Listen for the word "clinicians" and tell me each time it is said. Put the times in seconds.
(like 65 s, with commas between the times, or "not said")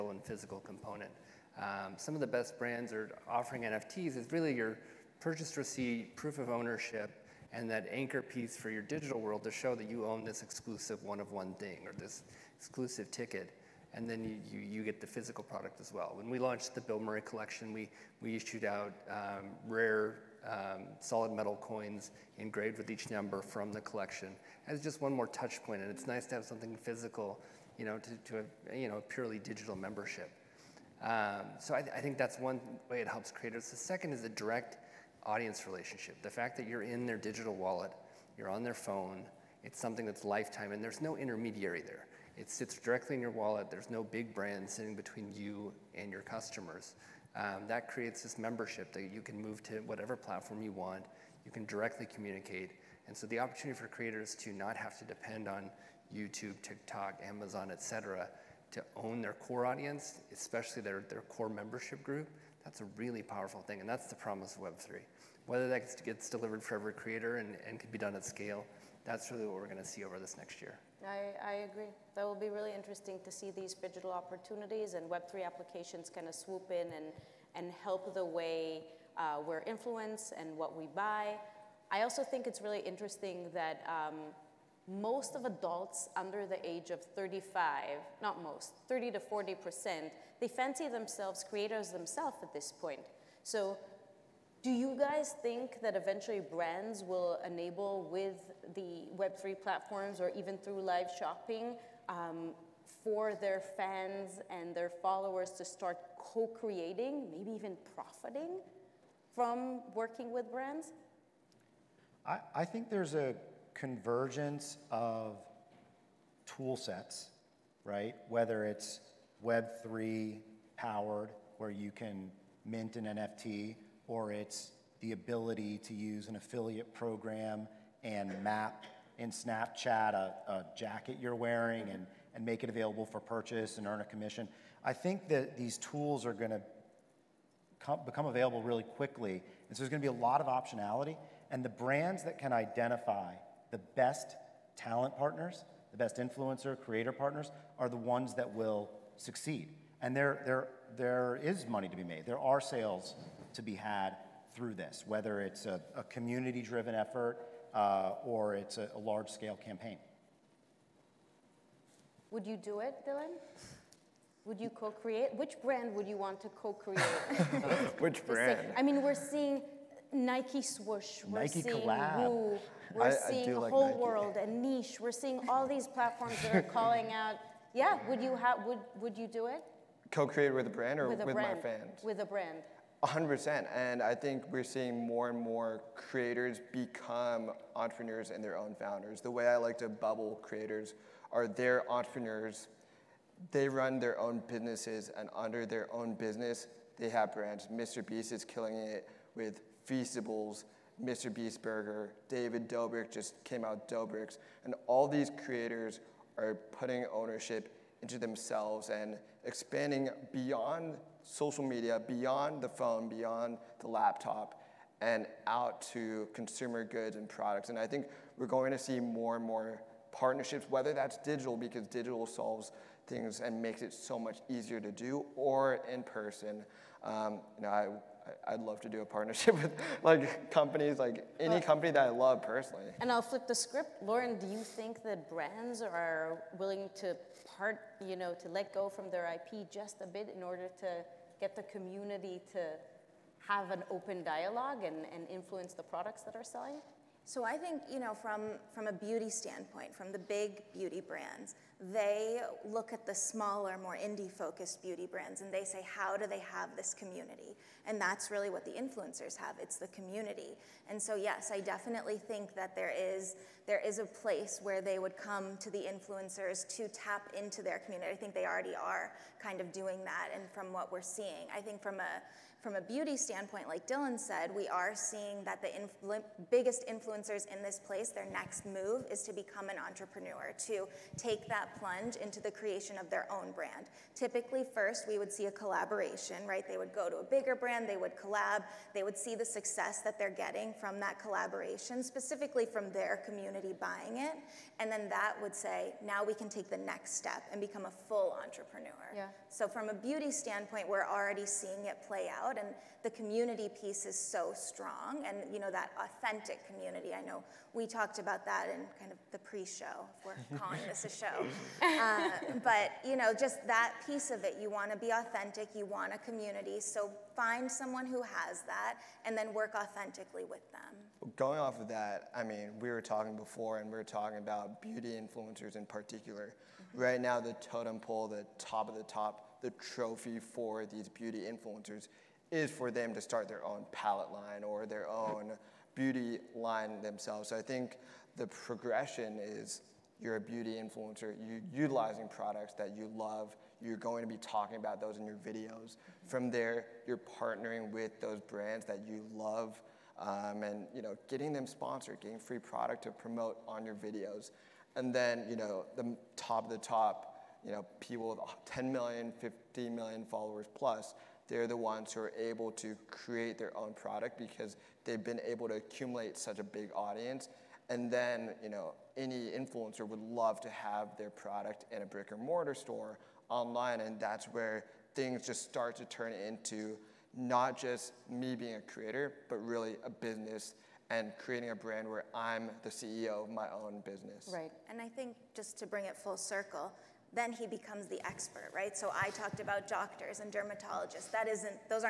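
not said.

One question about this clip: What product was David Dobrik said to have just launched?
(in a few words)
Doughbrik's.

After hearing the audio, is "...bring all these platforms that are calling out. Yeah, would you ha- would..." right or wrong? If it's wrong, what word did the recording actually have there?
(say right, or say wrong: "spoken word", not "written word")
wrong: "seeing", not "bring".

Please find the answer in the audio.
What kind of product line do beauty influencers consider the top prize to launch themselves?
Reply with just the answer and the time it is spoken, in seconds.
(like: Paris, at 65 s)
palette line, at 333 s.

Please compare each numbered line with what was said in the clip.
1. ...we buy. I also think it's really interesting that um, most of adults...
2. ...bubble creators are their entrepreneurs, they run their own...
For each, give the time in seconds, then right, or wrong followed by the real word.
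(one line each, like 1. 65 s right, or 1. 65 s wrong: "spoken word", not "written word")
1. 80 s right
2. 189 s right.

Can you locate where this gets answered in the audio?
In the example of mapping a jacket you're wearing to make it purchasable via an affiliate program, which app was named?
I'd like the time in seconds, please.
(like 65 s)
129 s.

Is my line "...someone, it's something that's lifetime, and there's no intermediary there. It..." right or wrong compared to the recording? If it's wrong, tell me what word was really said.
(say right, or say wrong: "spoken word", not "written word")
wrong: "phone", not "someone".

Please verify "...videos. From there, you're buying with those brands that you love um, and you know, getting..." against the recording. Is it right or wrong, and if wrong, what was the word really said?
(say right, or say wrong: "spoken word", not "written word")
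wrong: "partnering", not "buying".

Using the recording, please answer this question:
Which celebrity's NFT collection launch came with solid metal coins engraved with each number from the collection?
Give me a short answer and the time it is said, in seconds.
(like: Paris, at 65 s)
Bill Murray, at 16 s.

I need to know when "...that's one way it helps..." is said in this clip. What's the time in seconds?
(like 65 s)
32 s.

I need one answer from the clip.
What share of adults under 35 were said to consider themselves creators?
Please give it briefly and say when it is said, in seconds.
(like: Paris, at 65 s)
30 to 40%, at 88 s.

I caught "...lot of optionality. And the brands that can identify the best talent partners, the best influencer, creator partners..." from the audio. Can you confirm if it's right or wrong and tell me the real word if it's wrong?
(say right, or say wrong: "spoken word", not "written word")
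right.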